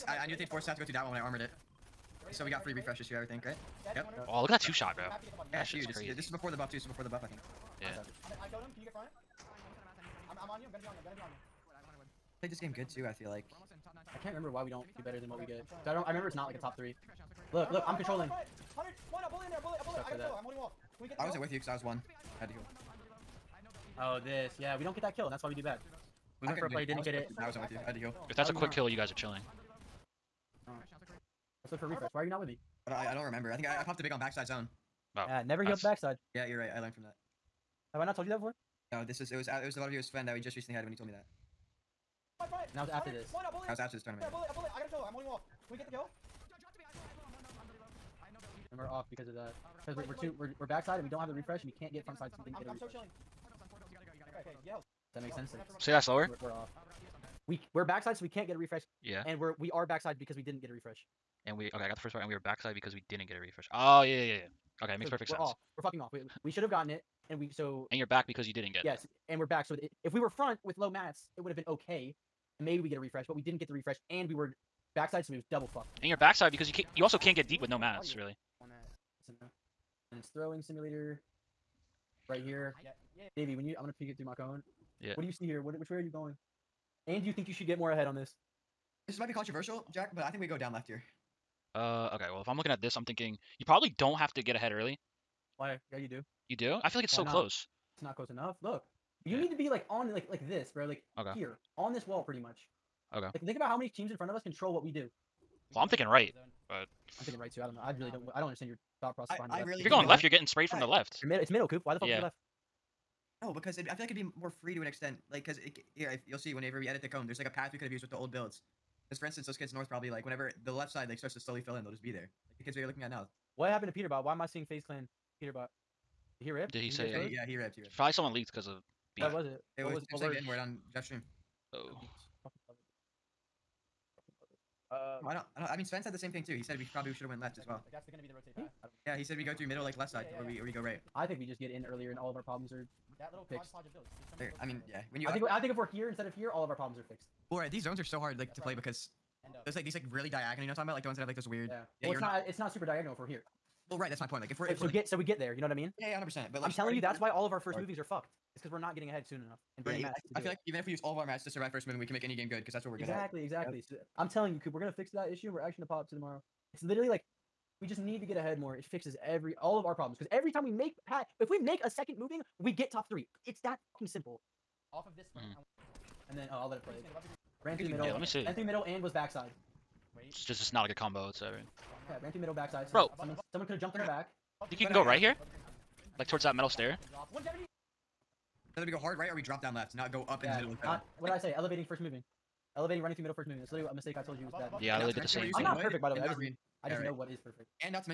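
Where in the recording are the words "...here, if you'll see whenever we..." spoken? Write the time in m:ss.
1:55.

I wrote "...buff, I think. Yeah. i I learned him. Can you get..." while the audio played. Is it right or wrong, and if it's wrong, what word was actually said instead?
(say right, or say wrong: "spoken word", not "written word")
wrong: "killed", not "learned".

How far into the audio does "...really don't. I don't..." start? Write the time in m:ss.
1:47.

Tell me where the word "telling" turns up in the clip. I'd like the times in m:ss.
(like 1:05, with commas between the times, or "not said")
2:36, 2:44.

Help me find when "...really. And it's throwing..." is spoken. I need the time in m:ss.
1:18.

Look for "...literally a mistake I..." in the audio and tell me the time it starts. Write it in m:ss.
3:13.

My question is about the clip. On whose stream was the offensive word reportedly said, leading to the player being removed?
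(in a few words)
Jeff's.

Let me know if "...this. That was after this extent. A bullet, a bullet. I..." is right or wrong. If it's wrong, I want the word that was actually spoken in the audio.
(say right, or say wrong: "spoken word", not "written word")
wrong: "tournament", not "extent".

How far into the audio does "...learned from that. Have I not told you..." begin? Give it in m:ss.
0:36.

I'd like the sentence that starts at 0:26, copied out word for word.
We went for a play, didn't was, get it.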